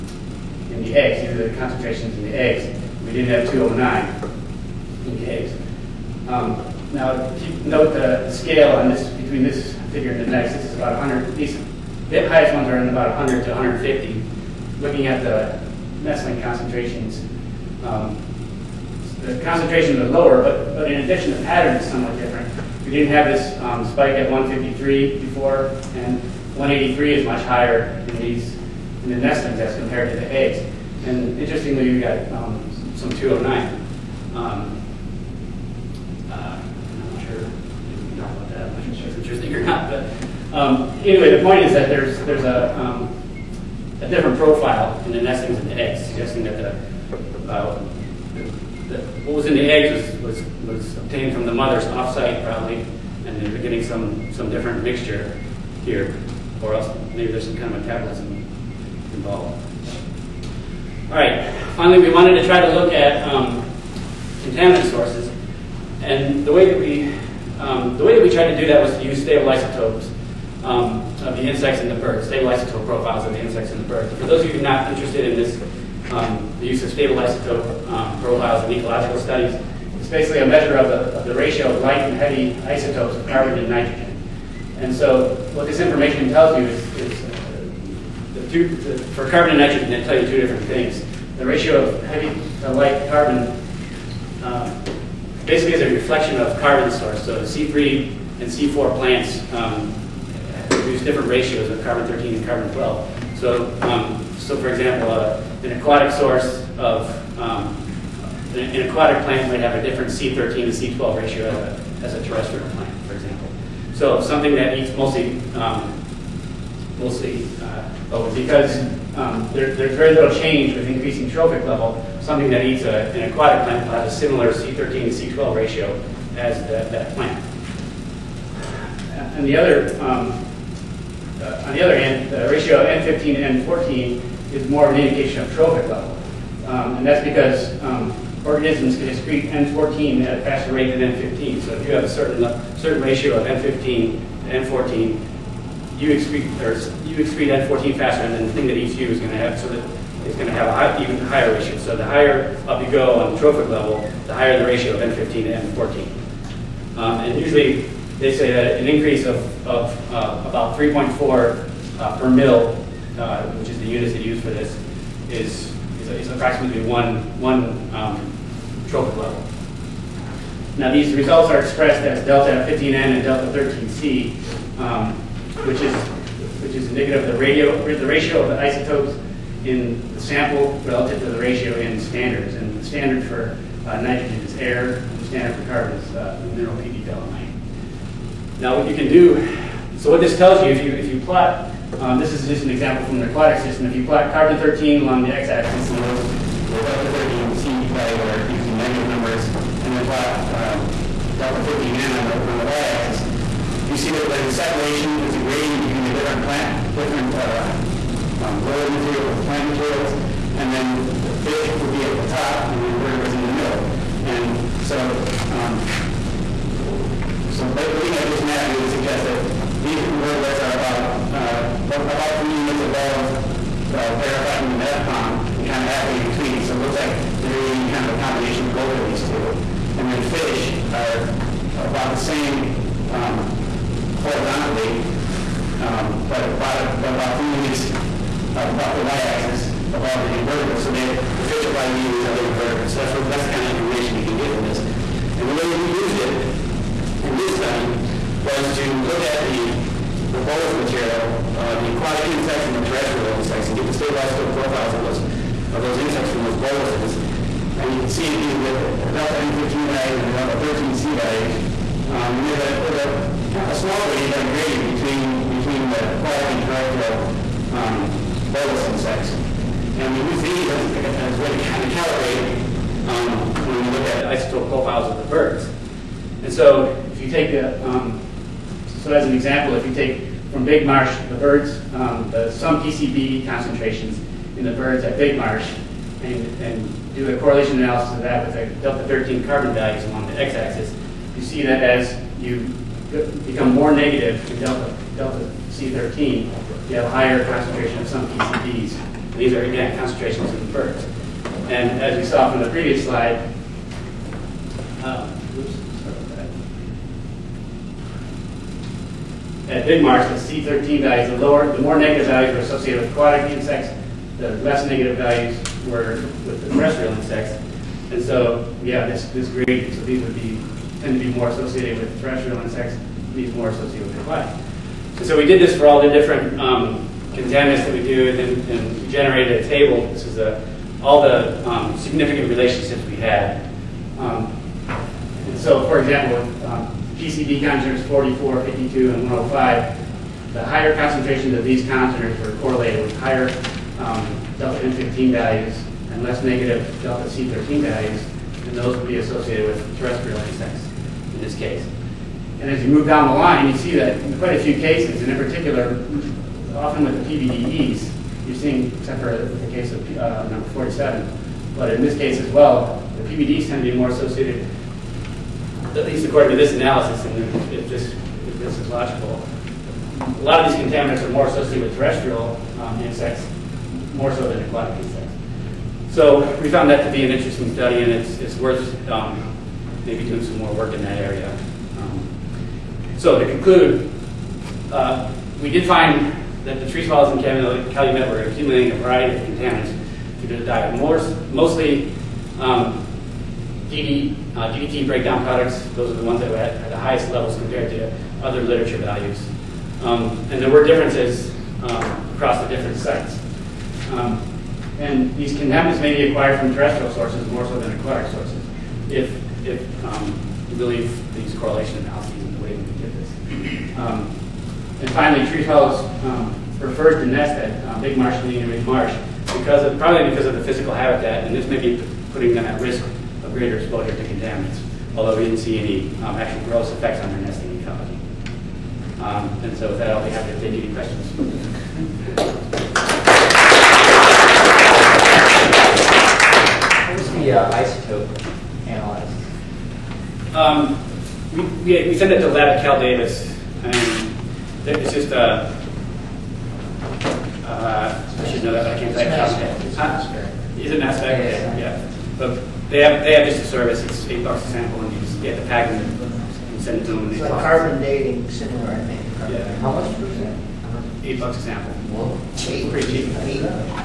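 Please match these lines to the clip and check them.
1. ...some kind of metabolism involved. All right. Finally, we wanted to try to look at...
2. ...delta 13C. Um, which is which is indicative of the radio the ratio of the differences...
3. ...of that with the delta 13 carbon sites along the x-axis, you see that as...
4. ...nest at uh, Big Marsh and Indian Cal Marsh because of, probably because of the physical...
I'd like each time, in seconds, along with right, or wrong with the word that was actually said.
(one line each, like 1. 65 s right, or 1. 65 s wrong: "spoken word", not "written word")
1. 57 s right
2. 173 s wrong: "isotopes", not "differences"
3. 288 s wrong: "values", not "sites"
4. 417 s wrong: "Ridge", not "Cal".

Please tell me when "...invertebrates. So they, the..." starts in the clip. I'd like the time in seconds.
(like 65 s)
240 s.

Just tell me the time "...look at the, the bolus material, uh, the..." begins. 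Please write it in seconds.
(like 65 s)
249 s.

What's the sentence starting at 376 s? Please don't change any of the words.
So we found that to be an interesting study, and it's, it's worth um, maybe doing some more work in that area.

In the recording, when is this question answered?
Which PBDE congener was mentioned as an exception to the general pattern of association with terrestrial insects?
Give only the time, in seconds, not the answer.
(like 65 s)
360 s.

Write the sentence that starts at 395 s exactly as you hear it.
Those are the ones that were at, at the highest levels compared to other literature values.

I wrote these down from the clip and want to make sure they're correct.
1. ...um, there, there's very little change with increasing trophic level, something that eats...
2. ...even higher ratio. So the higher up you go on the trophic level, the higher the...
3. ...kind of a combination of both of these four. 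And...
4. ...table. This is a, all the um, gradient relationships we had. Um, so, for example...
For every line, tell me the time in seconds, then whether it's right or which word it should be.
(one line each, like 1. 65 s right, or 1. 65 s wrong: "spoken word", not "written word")
1. 119 s right
2. 151 s right
3. 227 s wrong: "two", not "four"
4. 329 s wrong: "significant", not "gradient".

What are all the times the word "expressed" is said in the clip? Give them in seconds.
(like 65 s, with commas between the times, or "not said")
171 s.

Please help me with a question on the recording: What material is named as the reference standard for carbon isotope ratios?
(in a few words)
PD dolomite.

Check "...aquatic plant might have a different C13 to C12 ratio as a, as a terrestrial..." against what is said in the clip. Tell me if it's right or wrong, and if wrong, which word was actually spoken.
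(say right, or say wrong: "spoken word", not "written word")
right.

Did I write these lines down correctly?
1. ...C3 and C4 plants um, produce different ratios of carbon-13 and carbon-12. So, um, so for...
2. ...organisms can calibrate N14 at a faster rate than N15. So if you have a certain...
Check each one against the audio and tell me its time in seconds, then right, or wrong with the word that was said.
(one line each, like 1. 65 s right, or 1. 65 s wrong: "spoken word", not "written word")
1. 97 s right
2. 138 s wrong: "excrete", not "calibrate".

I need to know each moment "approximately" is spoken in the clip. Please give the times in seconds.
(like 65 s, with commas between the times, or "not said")
166 s.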